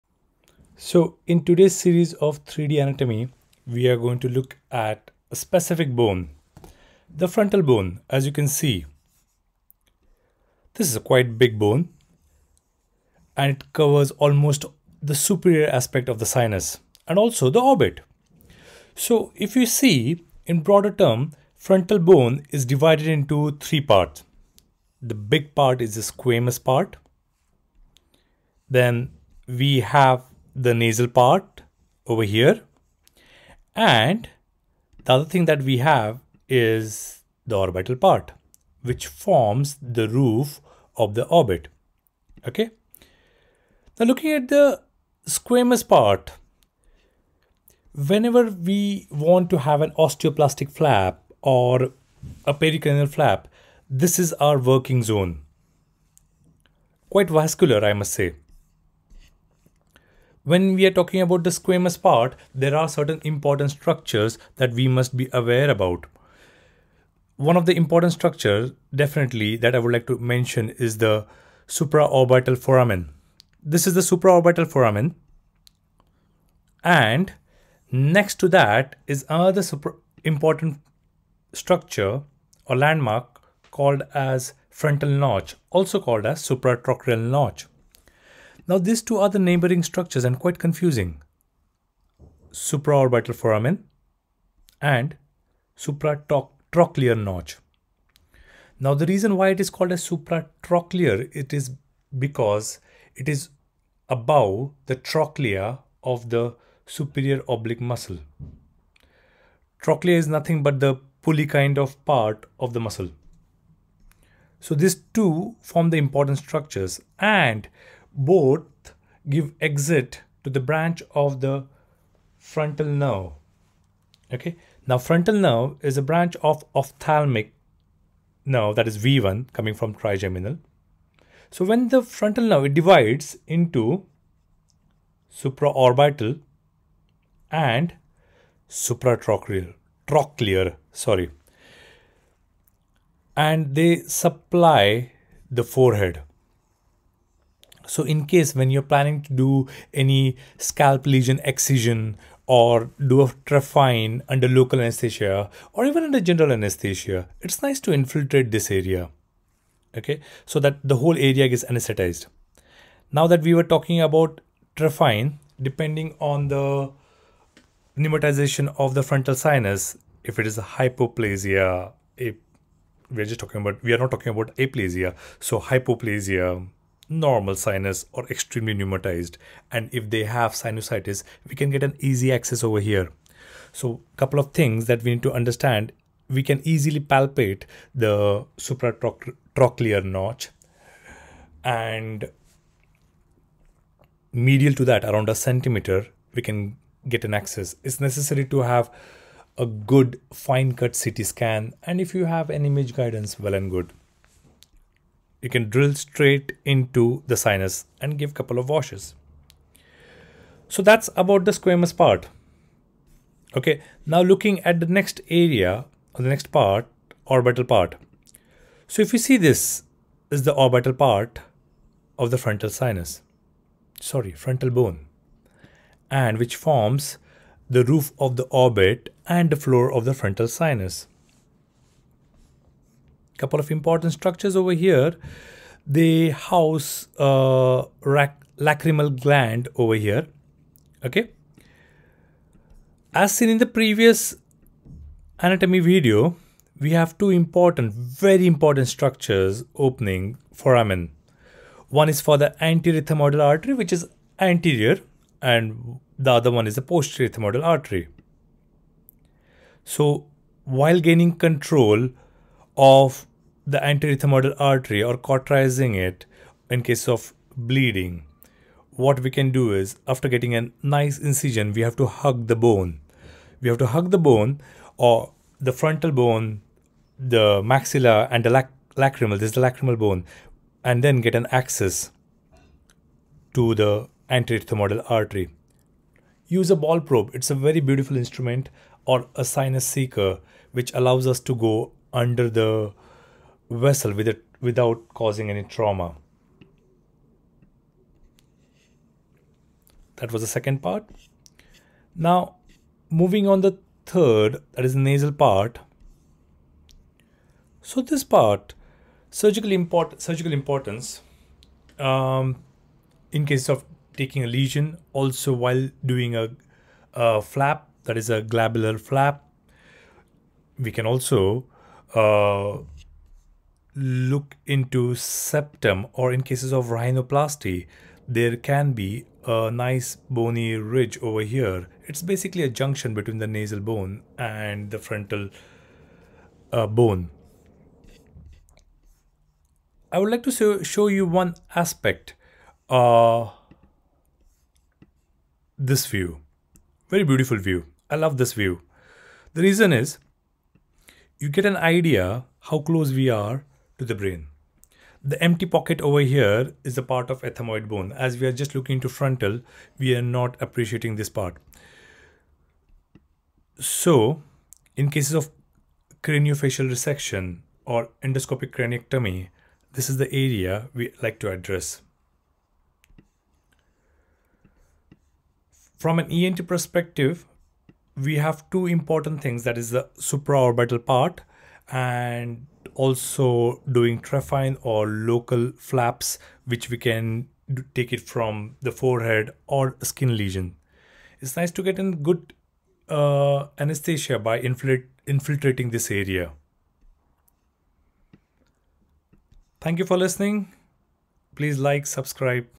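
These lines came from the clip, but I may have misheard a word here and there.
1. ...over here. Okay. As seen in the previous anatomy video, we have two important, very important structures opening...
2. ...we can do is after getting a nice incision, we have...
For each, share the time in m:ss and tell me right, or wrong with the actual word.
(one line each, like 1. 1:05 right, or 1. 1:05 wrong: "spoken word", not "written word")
1. 3:59 right
2. 4:29 right.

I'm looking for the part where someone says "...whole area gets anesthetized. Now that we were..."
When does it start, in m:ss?
2:40.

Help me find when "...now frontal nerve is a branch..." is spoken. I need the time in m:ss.
2:04.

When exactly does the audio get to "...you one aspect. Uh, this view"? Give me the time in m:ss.
5:41.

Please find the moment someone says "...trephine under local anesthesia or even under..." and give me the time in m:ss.
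2:33.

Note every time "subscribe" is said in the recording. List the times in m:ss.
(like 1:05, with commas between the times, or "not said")
6:42.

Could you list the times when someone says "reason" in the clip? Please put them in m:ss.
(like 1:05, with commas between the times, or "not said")
1:39, 5:49.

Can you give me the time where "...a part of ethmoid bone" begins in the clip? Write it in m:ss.
5:56.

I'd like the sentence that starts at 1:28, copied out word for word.
Now these two are the neighboring structures and quite confusing.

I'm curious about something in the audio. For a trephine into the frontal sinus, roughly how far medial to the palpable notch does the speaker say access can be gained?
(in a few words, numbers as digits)
A centimeter.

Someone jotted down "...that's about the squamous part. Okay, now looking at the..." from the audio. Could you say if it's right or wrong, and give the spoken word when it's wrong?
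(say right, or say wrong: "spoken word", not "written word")
right.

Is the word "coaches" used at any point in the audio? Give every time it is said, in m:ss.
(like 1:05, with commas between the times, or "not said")
not said.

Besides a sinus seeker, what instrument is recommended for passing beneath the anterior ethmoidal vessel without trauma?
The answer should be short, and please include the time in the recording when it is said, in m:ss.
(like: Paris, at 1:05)
Ball probe, at 4:46.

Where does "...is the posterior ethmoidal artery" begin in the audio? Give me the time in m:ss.
4:16.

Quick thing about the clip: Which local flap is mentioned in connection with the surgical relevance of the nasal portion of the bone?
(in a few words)
Glabellar flap.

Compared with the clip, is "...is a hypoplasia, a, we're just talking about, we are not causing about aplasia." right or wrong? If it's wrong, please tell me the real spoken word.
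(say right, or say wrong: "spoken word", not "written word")
wrong: "talking", not "causing".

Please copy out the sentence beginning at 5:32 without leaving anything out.
It's basically a junction between the nasal bone and the frontal uh, bone.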